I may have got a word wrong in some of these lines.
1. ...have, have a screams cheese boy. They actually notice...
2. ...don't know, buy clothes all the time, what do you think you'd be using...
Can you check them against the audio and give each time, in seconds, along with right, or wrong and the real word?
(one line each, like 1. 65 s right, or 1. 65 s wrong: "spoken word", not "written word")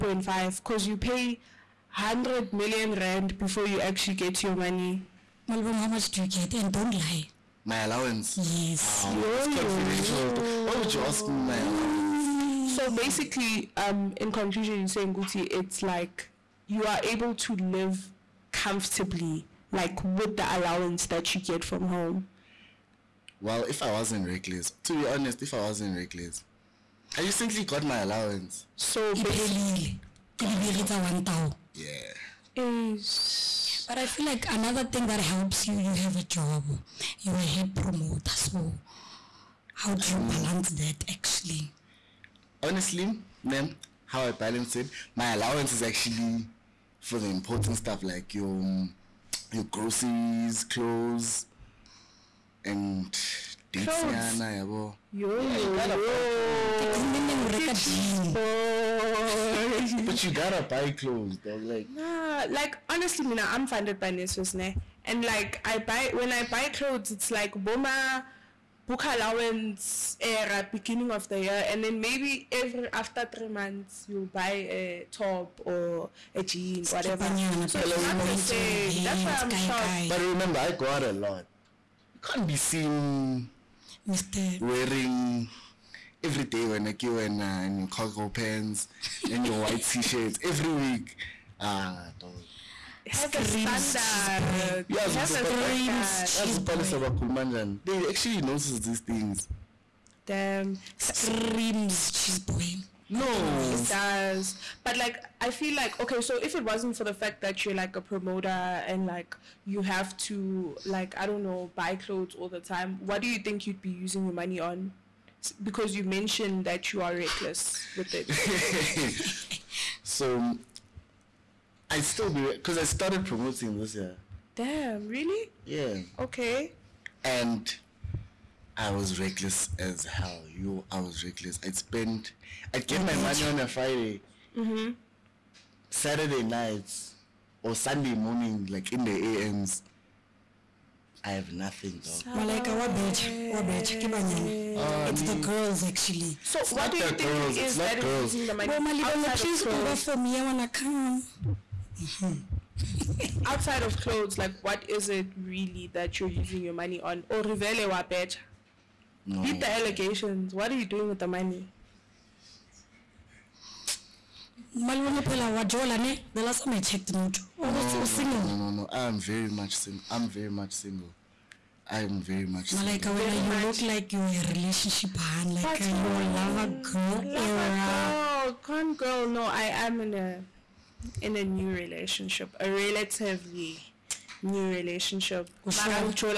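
1. 94 s right
2. 111 s right.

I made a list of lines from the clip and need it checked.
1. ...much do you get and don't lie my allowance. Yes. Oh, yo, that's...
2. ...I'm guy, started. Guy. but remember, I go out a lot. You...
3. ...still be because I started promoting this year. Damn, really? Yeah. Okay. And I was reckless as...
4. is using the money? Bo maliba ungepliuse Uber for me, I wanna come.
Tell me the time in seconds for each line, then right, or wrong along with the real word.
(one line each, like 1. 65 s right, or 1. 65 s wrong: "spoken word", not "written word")
1. 5 s right
2. 79 s wrong: "shocked", not "started"
3. 121 s right
4. 148 s right.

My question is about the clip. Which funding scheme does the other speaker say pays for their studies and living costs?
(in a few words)
NSFAS.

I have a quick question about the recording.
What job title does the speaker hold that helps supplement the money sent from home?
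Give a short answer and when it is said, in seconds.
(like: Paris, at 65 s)
Head promoter, at 37 s.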